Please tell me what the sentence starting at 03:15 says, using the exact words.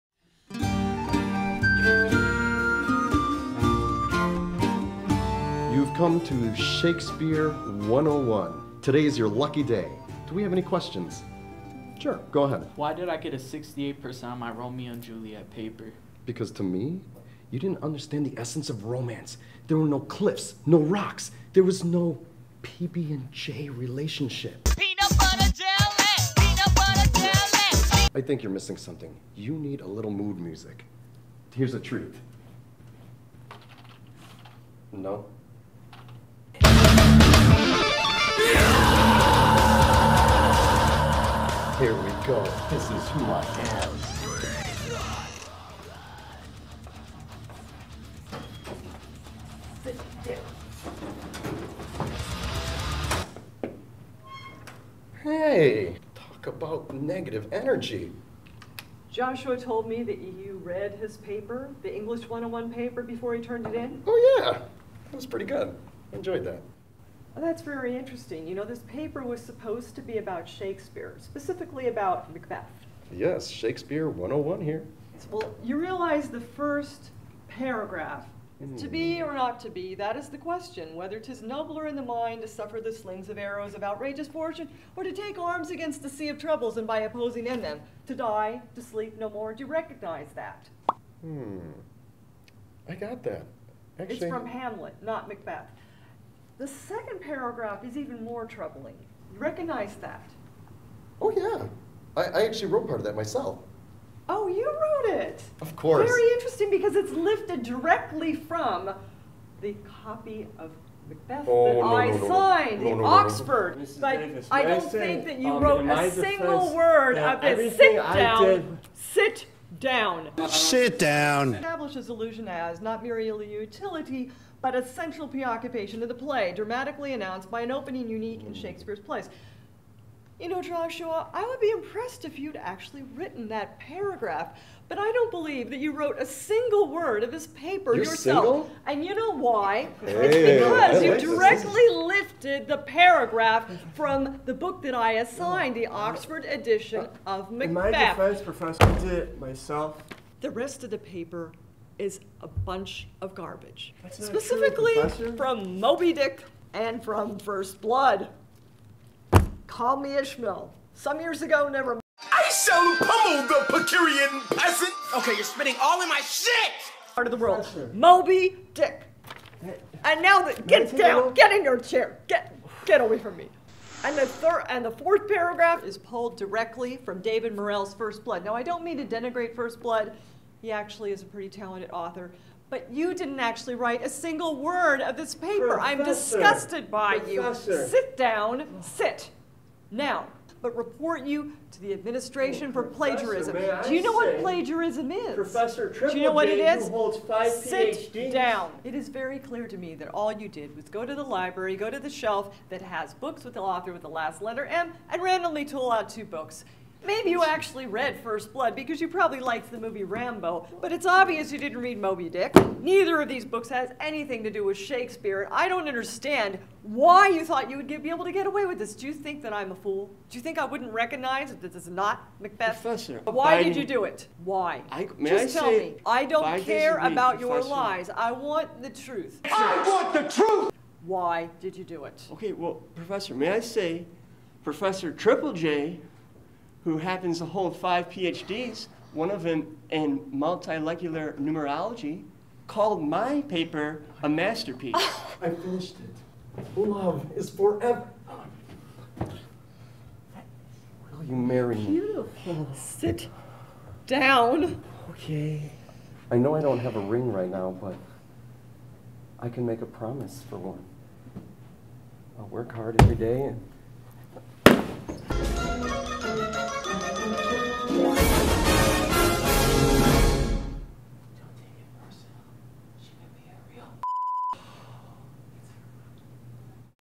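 Professor Triple Do you know what it is?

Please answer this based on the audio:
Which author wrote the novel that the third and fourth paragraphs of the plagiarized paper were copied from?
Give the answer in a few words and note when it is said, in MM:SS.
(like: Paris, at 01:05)
David Morrell, at 02:57.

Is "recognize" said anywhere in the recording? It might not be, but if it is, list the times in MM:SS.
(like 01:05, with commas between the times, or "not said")
01:29, 01:39, 03:40.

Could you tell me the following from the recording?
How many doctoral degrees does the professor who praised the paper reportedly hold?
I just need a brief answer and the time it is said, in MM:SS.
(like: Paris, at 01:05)
5, at 03:57.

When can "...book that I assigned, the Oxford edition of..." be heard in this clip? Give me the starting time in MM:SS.
02:24.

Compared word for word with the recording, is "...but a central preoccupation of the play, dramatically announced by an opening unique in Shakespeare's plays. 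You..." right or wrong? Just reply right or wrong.
right.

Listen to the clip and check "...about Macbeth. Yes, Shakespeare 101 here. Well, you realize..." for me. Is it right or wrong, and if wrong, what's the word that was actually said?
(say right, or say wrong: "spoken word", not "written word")
right.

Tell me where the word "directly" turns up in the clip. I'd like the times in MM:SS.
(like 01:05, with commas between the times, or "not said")
01:47, 02:21, 02:56.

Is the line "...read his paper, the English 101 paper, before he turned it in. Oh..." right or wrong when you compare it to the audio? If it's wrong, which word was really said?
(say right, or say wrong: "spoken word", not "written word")
right.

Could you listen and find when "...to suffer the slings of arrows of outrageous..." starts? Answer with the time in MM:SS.
01:22.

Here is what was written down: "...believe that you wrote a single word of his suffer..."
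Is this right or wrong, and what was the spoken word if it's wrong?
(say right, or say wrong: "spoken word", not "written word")
wrong: "paper", not "suffer".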